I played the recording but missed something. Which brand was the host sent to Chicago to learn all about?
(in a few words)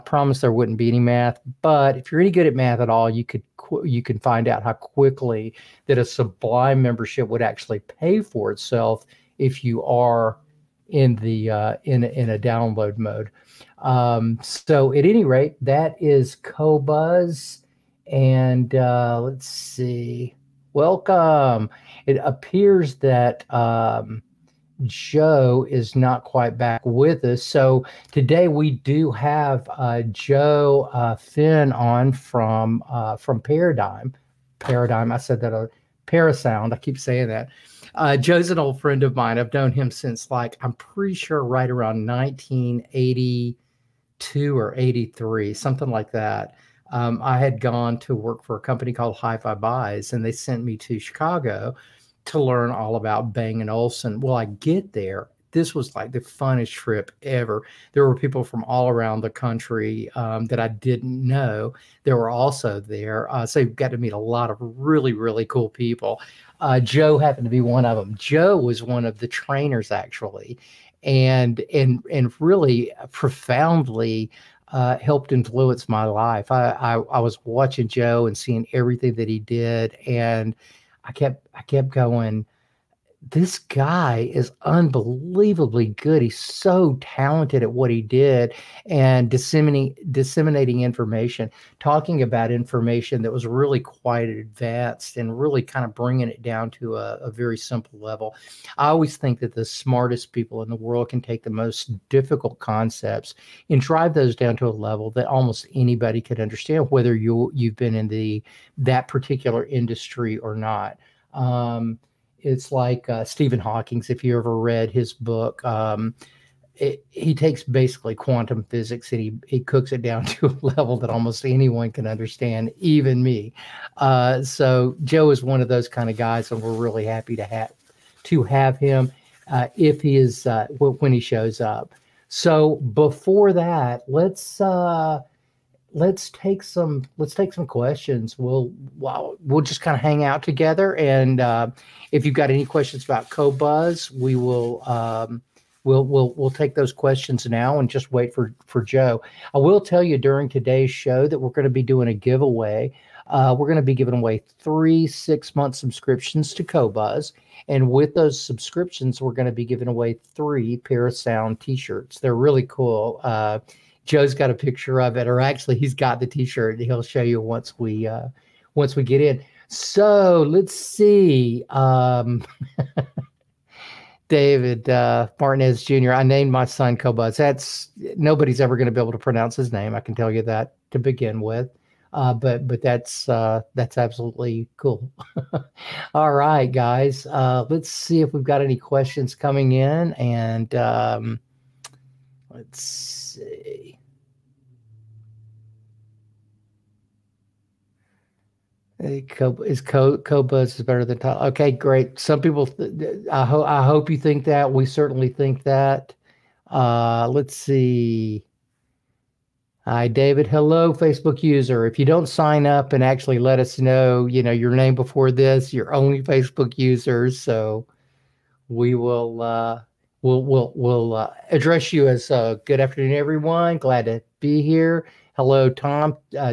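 Bang and Olufsen.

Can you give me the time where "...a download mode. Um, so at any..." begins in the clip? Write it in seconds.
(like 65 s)
12 s.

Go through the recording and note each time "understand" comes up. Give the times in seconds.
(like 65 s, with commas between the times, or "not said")
106 s, 122 s.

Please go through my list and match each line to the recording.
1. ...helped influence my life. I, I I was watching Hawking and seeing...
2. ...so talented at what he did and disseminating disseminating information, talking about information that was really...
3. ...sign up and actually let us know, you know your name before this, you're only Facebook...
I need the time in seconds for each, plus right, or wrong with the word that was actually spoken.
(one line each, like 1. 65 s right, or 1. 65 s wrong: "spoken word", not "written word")
1. 74 s wrong: "Joe", not "Hawking"
2. 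86 s right
3. 212 s right.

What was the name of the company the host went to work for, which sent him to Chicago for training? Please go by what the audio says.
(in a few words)
Hi-Fi Buys.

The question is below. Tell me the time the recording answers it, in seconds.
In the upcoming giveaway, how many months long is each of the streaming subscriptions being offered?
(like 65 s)
155 s.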